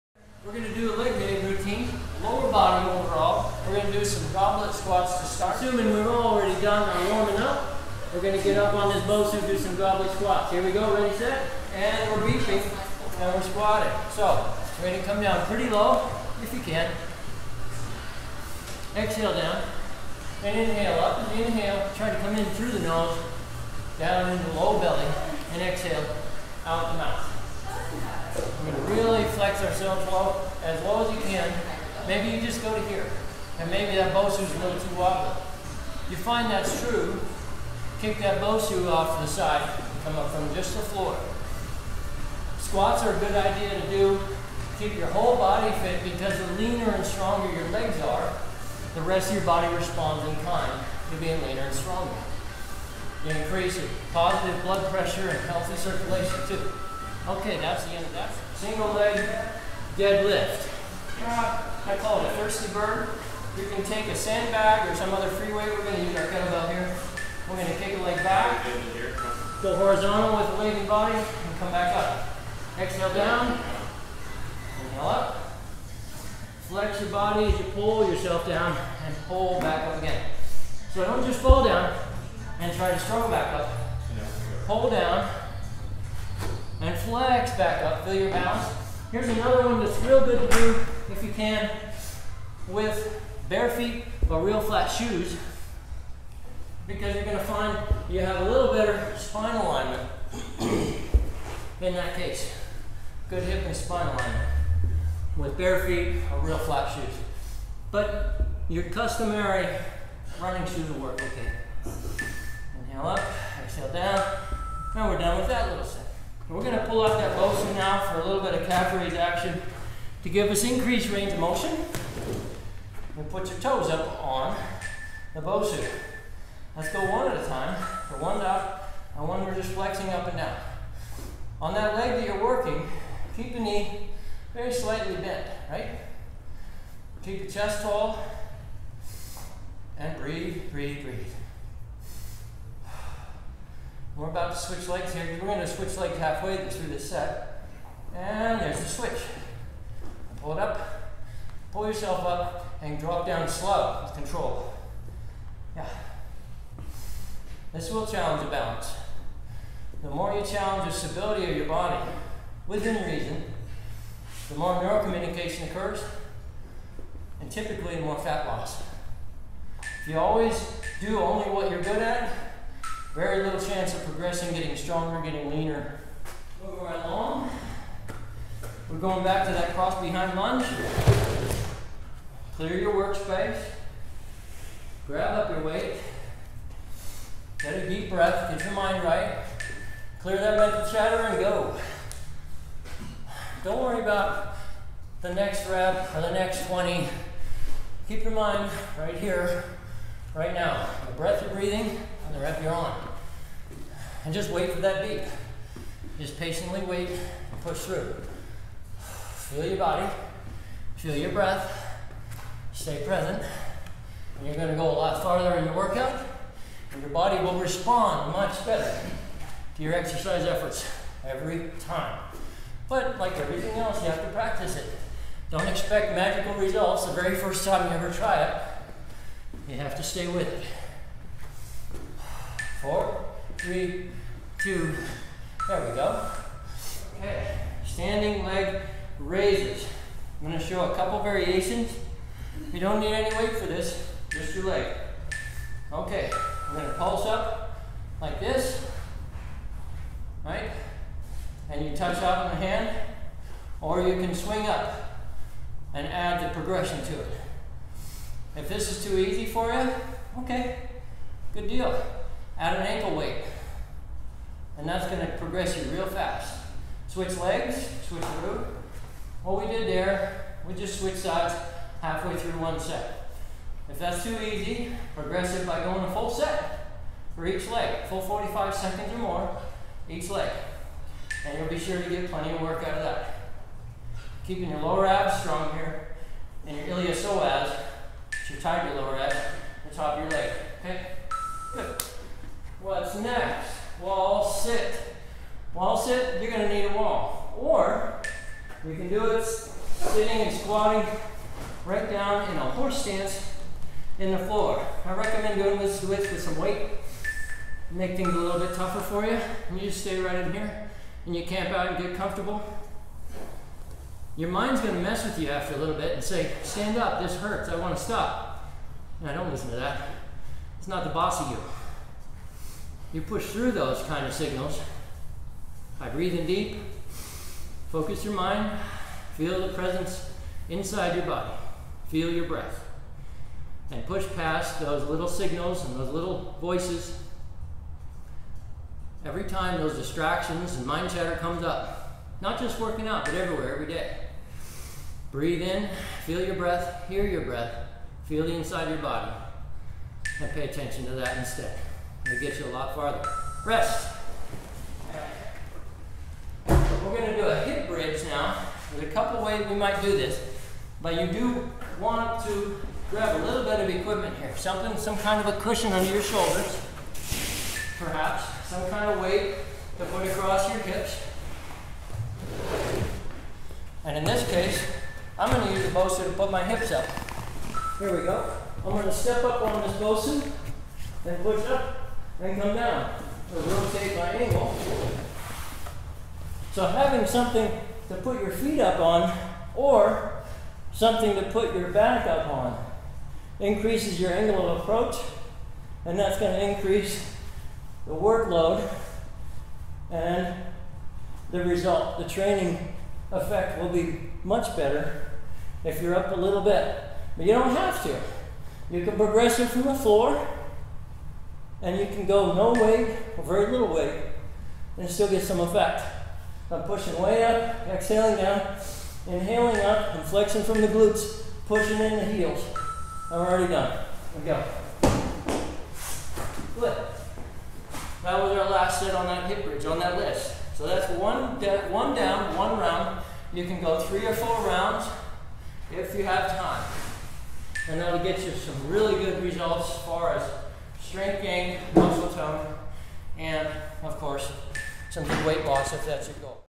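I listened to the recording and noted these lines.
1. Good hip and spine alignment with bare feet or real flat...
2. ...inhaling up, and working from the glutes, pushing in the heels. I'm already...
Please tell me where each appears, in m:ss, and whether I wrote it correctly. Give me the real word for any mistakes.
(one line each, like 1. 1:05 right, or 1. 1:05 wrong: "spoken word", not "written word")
1. 1:43 right
2. 6:59 wrong: "flexing", not "working".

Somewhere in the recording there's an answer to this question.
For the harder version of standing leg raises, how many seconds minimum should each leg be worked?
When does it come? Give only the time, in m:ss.
4:38.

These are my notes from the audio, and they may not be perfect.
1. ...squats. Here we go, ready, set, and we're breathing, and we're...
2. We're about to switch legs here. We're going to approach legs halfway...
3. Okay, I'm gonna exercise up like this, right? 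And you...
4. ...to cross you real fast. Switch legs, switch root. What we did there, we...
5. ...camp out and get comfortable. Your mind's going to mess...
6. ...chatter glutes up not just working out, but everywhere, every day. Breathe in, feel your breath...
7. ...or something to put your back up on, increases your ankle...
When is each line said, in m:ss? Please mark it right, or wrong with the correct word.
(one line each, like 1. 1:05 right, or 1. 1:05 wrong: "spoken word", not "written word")
1. 0:10 wrong: "beefing", not "breathing"
2. 2:24 wrong: "switch", not "approach"
3. 4:05 wrong: "pulse", not "exercise"
4. 4:25 wrong: "progress", not "cross"
5. 5:11 right
6. 5:41 wrong: "comes", not "glutes"
7. 6:29 wrong: "angle", not "ankle".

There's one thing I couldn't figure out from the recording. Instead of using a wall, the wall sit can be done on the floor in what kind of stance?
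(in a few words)
Horse stance.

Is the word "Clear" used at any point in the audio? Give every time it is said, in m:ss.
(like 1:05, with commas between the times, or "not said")
3:02, 3:10.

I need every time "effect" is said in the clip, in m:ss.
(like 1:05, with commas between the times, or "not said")
6:43, 6:55.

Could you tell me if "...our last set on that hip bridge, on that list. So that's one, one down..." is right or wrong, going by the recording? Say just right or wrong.
right.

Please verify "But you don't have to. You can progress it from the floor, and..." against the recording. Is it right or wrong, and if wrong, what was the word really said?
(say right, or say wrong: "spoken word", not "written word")
right.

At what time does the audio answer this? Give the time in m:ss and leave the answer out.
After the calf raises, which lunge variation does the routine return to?
2:59.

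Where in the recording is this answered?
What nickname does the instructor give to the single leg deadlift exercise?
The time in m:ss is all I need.
1:02.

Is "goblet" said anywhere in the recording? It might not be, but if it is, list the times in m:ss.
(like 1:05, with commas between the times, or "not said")
0:04, 0:09.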